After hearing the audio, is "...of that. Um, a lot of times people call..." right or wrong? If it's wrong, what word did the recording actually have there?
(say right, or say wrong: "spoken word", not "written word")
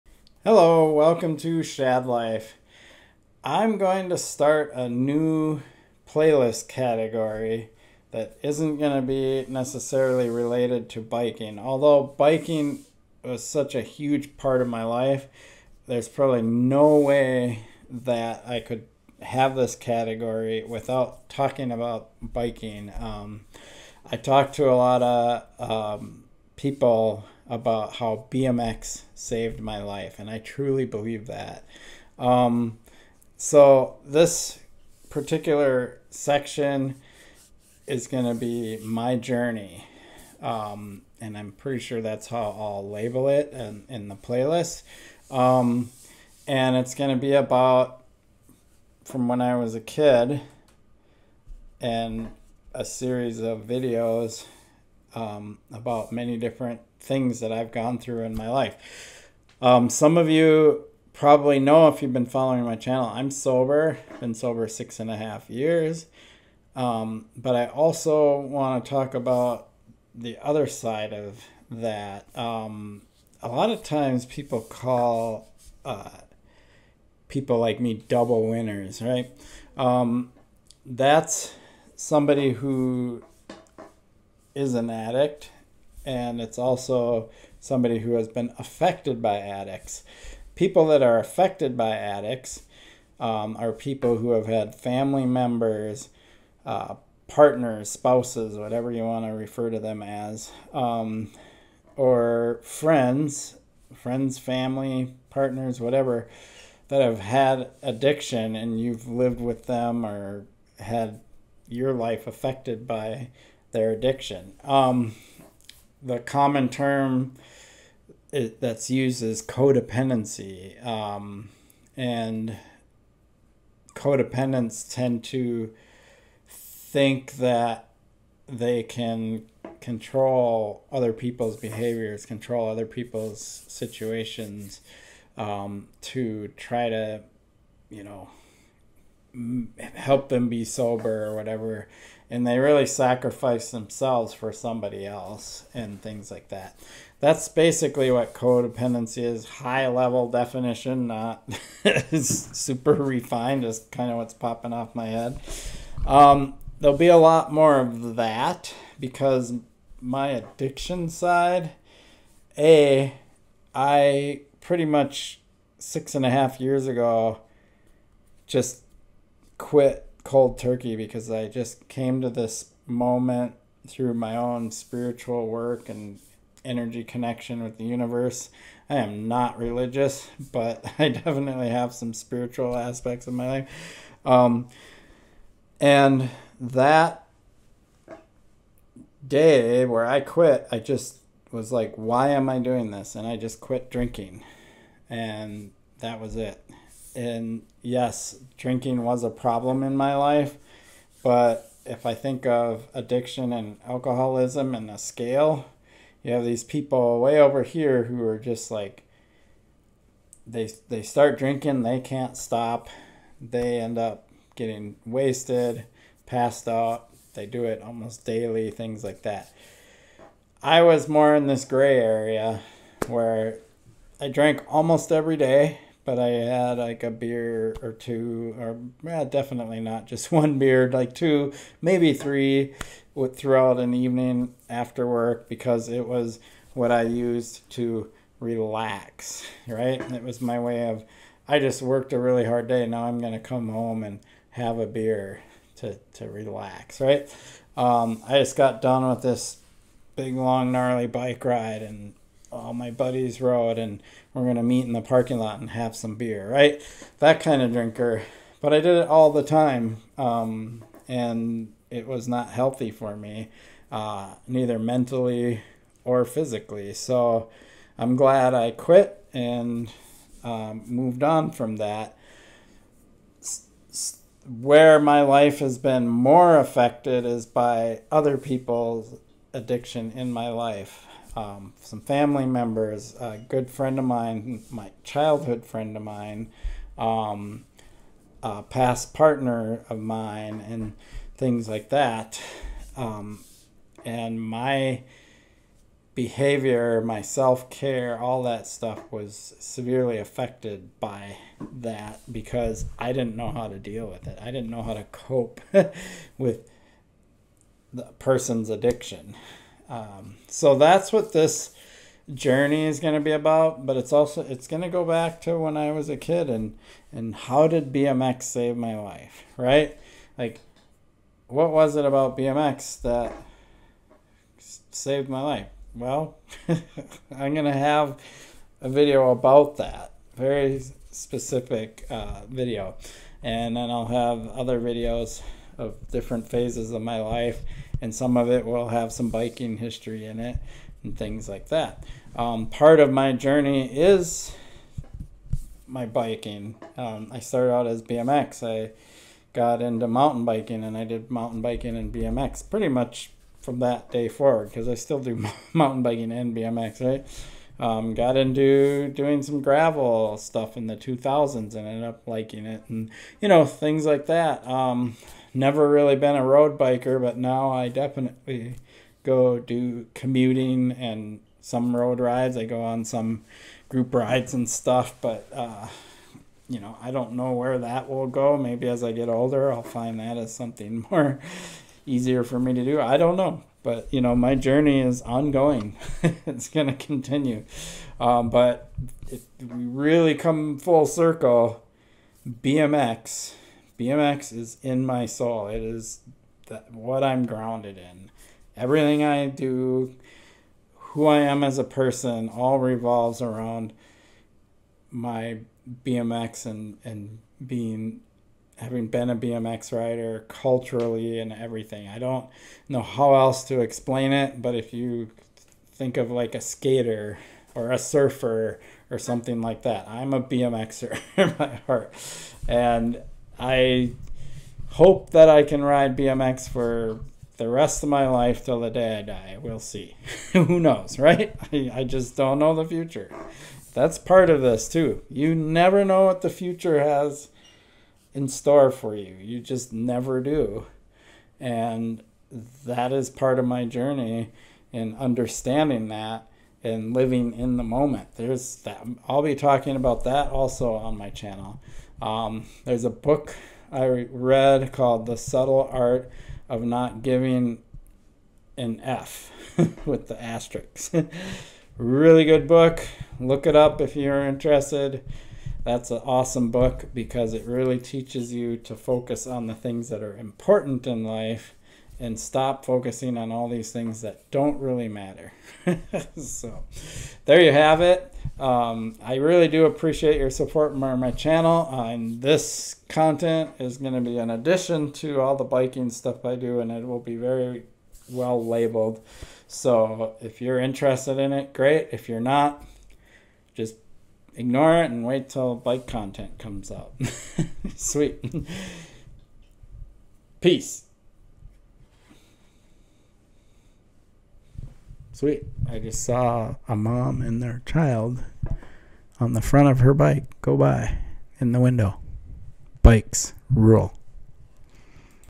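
right.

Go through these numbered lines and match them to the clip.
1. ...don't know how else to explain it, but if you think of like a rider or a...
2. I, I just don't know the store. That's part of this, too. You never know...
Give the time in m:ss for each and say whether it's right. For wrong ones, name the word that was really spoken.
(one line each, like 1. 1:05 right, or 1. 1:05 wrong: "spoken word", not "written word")
1. 6:52 wrong: "skater", not "rider"
2. 7:11 wrong: "future", not "store".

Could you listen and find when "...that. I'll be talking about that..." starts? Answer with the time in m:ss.
7:28.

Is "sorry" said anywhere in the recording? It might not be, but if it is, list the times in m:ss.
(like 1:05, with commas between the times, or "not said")
not said.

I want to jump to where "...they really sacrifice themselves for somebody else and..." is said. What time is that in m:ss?
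2:22.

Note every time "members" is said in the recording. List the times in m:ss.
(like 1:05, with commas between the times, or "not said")
1:35, 4:42.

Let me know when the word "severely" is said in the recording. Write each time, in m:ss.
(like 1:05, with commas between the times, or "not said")
4:59.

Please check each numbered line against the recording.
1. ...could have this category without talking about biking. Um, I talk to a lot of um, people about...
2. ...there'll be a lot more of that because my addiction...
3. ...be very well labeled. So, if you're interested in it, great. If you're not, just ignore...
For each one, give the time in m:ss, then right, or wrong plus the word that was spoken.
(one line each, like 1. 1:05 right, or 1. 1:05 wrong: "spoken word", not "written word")
1. 0:18 right
2. 2:36 right
3. 8:07 right.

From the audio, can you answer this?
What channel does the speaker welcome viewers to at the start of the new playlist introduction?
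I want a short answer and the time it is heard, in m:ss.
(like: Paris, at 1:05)
Shad Life, at 0:01.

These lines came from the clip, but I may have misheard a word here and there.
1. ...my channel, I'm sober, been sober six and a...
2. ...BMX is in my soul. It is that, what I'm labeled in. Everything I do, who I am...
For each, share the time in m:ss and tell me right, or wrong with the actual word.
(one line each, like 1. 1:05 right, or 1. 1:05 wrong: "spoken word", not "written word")
1. 1:02 right
2. 6:34 wrong: "grounded", not "labeled".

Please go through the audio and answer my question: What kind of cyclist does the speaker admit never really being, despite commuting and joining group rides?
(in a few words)
road biker.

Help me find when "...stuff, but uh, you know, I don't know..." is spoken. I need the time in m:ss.
6:14.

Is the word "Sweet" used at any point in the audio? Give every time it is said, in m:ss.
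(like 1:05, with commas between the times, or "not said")
8:17, 8:25.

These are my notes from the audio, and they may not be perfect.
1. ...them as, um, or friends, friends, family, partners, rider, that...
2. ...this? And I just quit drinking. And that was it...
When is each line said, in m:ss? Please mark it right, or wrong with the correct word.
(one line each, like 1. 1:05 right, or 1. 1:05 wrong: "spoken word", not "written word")
1. 1:39 wrong: "whatever", not "rider"
2. 3:12 right.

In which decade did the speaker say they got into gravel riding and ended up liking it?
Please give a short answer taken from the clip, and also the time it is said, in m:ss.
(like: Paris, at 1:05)
2000s, at 6:00.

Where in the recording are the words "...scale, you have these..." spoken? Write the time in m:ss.
3:24.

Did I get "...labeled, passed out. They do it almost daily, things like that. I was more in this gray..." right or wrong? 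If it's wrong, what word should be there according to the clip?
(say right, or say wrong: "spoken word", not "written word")
wrong: "wasted", not "labeled".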